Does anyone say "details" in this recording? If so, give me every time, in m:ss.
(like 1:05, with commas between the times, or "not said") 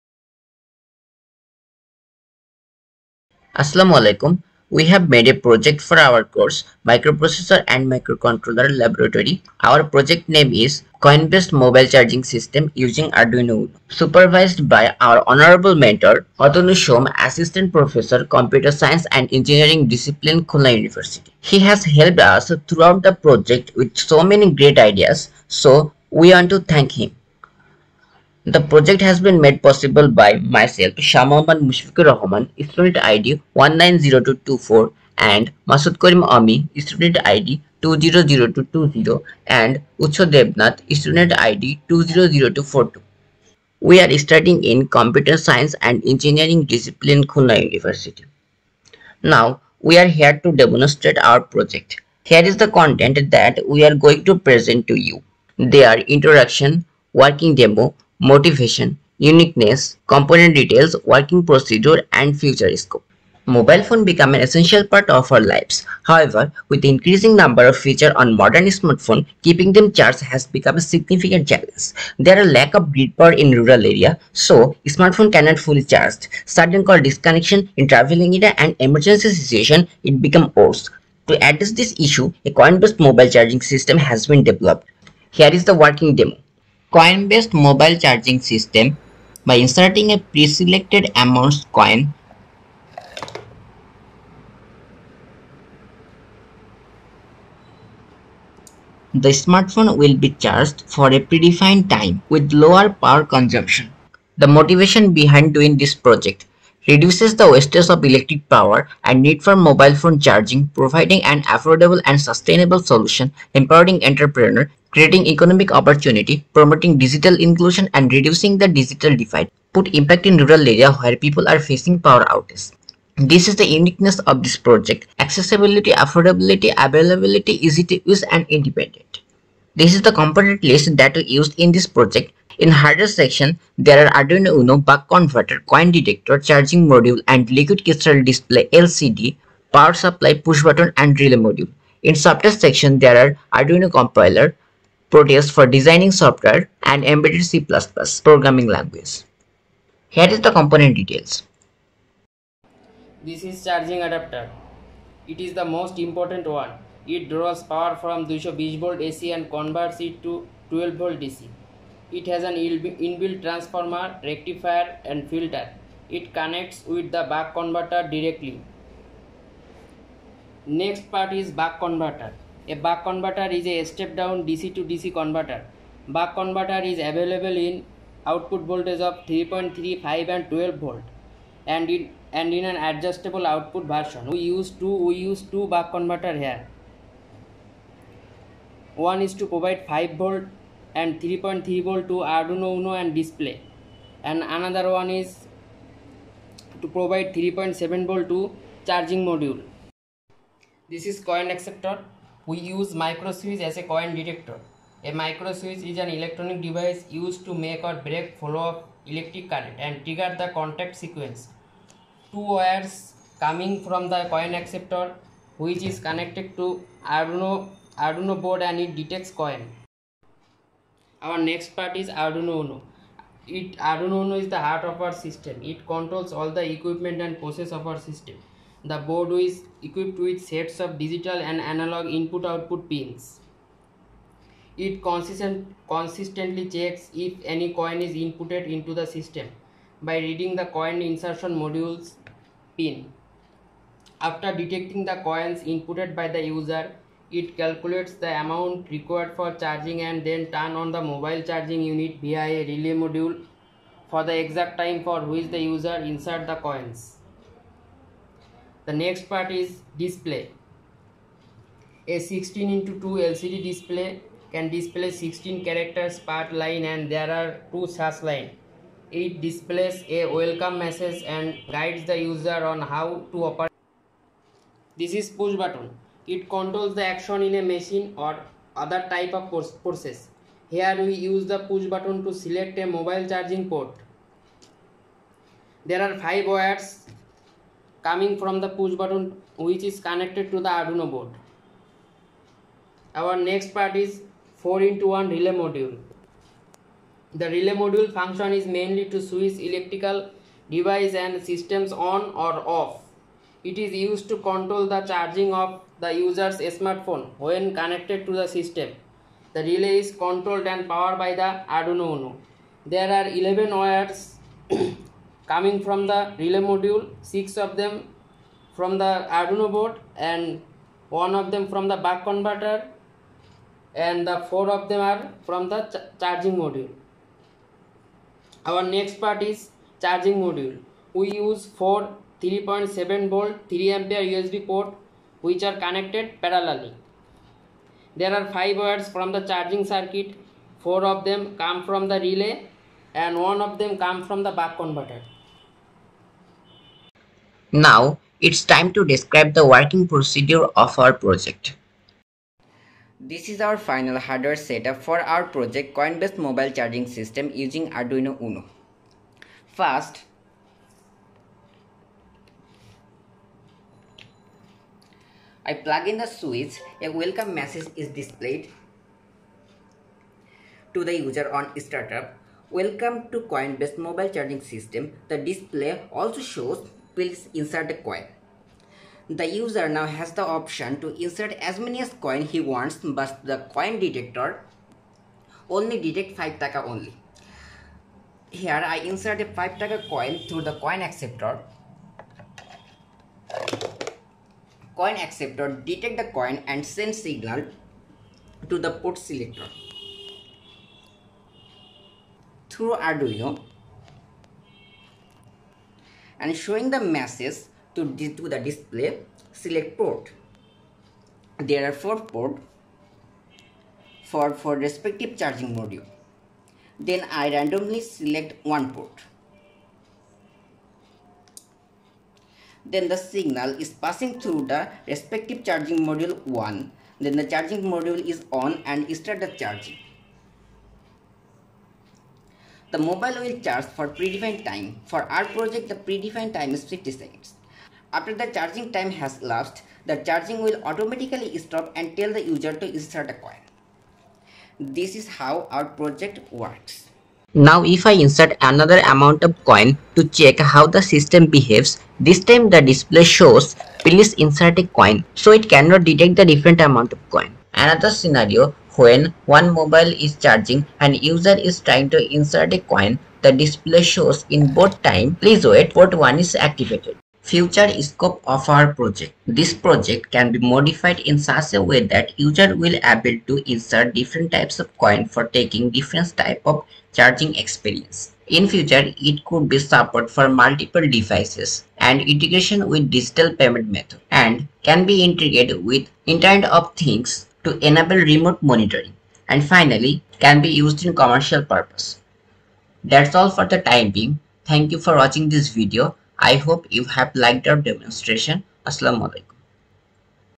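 1:00, 2:30.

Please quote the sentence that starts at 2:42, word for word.
It has an inbuilt transformer, rectifier and filter.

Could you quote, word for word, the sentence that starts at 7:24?
This is how our project works.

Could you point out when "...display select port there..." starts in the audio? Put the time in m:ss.
6:48.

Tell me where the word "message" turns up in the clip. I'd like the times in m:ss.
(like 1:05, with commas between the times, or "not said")
4:30, 6:07, 6:46.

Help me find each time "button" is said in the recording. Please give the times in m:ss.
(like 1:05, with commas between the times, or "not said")
2:20, 4:35, 4:41, 4:48.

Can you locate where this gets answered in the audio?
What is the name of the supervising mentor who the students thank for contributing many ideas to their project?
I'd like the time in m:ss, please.
0:16.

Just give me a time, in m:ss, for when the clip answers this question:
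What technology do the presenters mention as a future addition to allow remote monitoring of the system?
8:06.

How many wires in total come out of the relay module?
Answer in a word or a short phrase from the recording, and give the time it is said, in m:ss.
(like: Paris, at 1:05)
11, at 5:13.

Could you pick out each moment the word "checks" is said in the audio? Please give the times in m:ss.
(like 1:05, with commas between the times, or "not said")
3:56, 7:30.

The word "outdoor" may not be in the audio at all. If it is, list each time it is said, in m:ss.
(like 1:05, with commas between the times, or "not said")
not said.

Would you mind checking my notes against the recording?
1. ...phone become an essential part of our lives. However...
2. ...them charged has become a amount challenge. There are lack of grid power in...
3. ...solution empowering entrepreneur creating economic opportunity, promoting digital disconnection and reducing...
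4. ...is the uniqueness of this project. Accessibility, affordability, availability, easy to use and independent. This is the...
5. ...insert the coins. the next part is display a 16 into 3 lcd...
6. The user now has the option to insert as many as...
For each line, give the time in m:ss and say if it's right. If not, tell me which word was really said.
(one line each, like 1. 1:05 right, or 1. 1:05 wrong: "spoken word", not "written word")
1. 1:03 right
2. 1:09 wrong: "significant", not "amount"
3. 1:52 wrong: "inclusion", not "disconnection"
4. 2:03 right
5. 4:15 wrong: "2", not "3"
6. 6:19 right.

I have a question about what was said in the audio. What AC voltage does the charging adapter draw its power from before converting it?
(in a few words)
220 volt.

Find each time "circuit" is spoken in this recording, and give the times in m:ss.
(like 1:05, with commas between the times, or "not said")
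5:39.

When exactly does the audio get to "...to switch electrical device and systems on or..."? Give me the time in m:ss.
4:59.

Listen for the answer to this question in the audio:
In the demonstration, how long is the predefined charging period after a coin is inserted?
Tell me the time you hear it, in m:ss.
7:16.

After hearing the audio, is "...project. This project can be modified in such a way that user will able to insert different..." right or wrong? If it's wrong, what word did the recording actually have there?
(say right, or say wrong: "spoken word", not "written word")
right.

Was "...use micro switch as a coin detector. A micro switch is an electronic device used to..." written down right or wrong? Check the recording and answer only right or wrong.
right.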